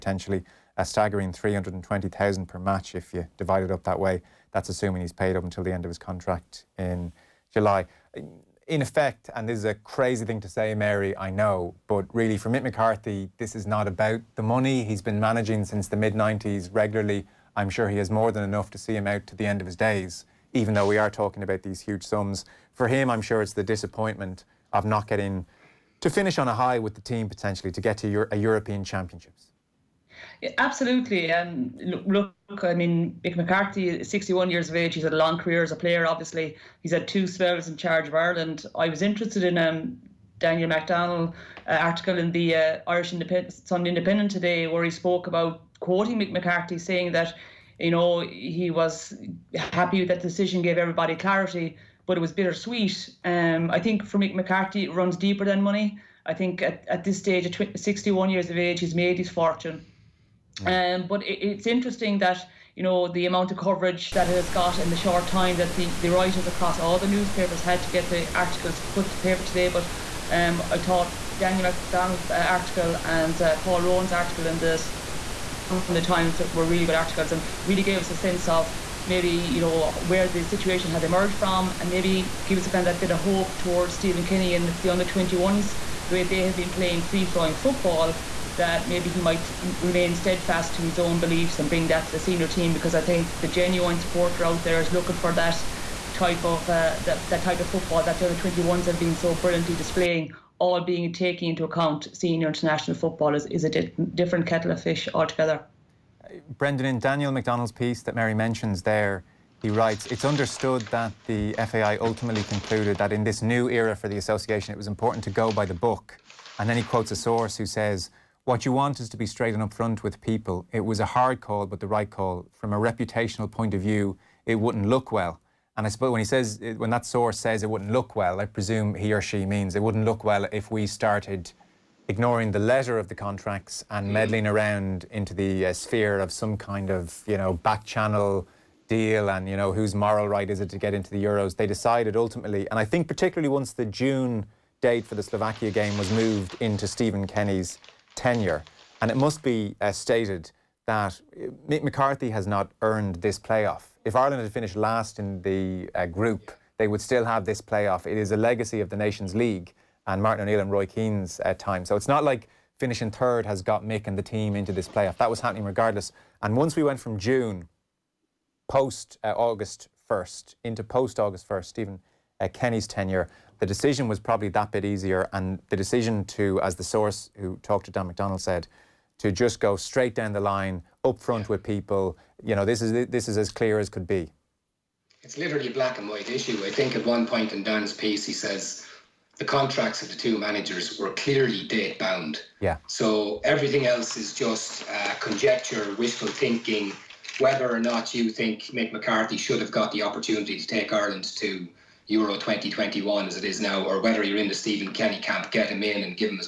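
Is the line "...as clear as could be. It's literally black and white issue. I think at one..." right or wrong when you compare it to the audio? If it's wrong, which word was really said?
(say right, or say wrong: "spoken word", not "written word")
right.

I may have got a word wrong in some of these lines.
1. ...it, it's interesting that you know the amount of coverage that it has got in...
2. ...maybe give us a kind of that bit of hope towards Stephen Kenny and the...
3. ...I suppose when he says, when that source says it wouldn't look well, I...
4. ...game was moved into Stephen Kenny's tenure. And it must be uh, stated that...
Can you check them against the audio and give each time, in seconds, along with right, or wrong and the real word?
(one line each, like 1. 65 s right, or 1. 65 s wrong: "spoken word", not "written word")
1. 61 s right
2. 81 s right
3. 125 s right
4. 145 s right.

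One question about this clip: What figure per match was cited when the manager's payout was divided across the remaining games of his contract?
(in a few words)
320,000.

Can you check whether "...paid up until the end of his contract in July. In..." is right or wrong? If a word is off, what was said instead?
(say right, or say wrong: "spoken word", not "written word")
right.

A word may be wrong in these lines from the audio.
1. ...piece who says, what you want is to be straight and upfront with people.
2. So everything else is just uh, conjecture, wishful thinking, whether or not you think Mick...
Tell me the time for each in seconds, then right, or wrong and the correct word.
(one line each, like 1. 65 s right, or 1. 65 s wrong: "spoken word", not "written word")
1. 117 s wrong: "source", not "piece"
2. 192 s right.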